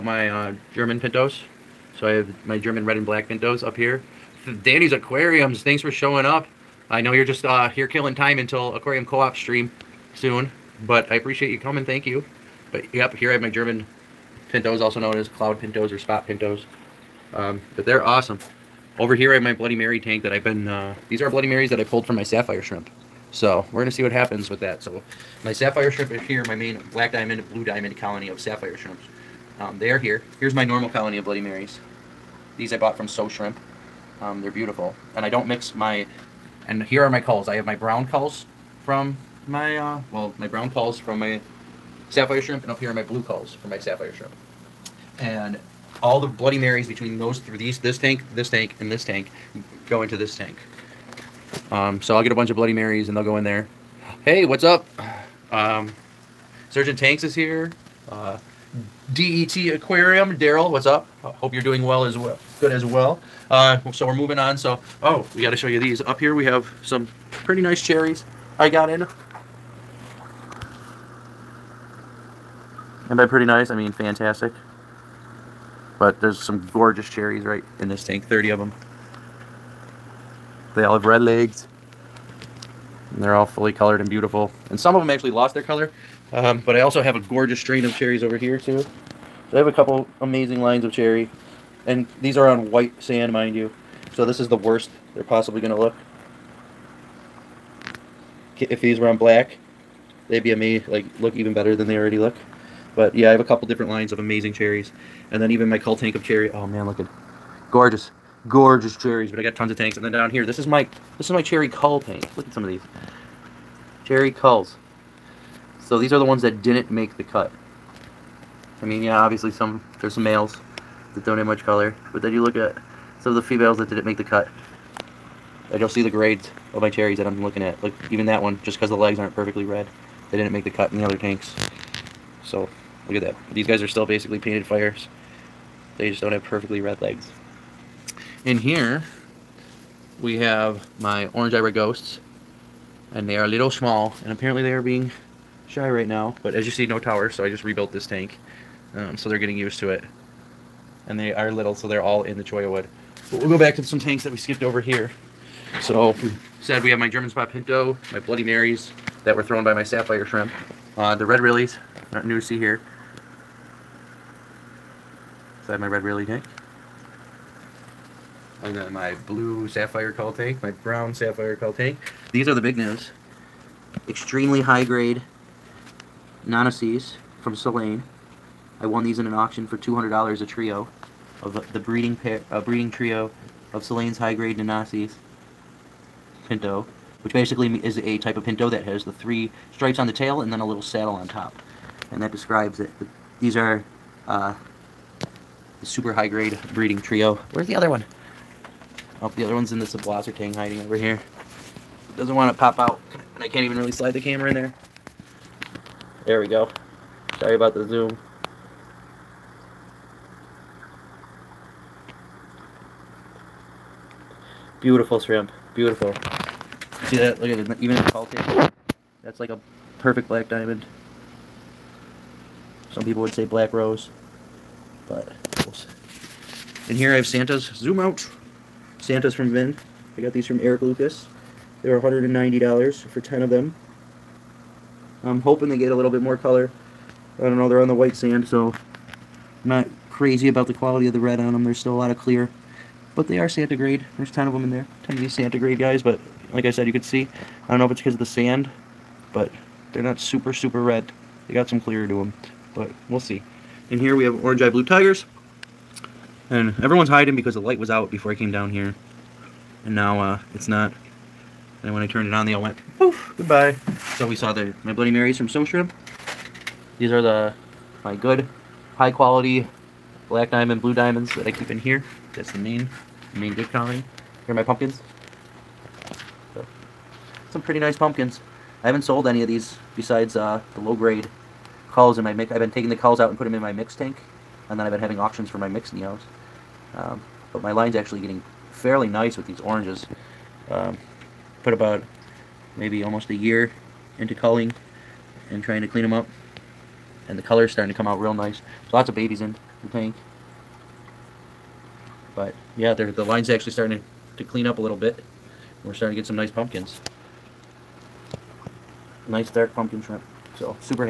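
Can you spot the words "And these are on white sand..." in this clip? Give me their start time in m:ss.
1:31.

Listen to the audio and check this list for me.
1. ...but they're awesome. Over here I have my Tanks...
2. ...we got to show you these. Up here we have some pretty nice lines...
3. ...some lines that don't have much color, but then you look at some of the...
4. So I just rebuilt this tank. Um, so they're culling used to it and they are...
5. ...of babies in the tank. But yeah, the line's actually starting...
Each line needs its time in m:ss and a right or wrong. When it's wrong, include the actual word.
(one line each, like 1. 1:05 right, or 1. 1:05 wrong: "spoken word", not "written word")
1. 0:17 wrong: "Bloody", not "Tanks"
2. 1:05 wrong: "cherries", not "lines"
3. 2:00 wrong: "males", not "lines"
4. 2:27 wrong: "getting", not "culling"
5. 4:59 right.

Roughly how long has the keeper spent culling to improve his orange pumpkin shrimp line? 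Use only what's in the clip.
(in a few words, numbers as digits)
almost a year.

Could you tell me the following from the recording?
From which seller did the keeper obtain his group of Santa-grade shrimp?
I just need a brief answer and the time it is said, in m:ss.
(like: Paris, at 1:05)
Eric Lucas, at 3:50.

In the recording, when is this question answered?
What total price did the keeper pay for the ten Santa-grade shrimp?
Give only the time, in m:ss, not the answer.
3:51.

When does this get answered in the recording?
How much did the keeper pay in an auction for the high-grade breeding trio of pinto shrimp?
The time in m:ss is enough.
2:59.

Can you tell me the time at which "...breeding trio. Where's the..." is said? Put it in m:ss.
3:16.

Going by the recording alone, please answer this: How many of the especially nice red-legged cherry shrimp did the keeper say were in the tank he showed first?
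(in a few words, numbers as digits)
30.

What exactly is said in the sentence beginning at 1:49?
But I got tons of tanks, and then down here, this is my this is my cherry cull tank.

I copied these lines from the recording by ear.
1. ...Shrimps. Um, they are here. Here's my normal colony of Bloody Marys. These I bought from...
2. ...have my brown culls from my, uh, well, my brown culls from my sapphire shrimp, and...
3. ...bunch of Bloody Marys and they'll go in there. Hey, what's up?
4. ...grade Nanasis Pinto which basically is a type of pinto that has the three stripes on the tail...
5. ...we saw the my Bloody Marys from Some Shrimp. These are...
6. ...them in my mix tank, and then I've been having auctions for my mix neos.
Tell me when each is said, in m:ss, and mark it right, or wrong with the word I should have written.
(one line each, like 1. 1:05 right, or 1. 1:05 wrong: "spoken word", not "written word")
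1. 0:28 right
2. 0:37 right
3. 0:52 right
4. 3:04 right
5. 4:24 right
6. 4:43 right.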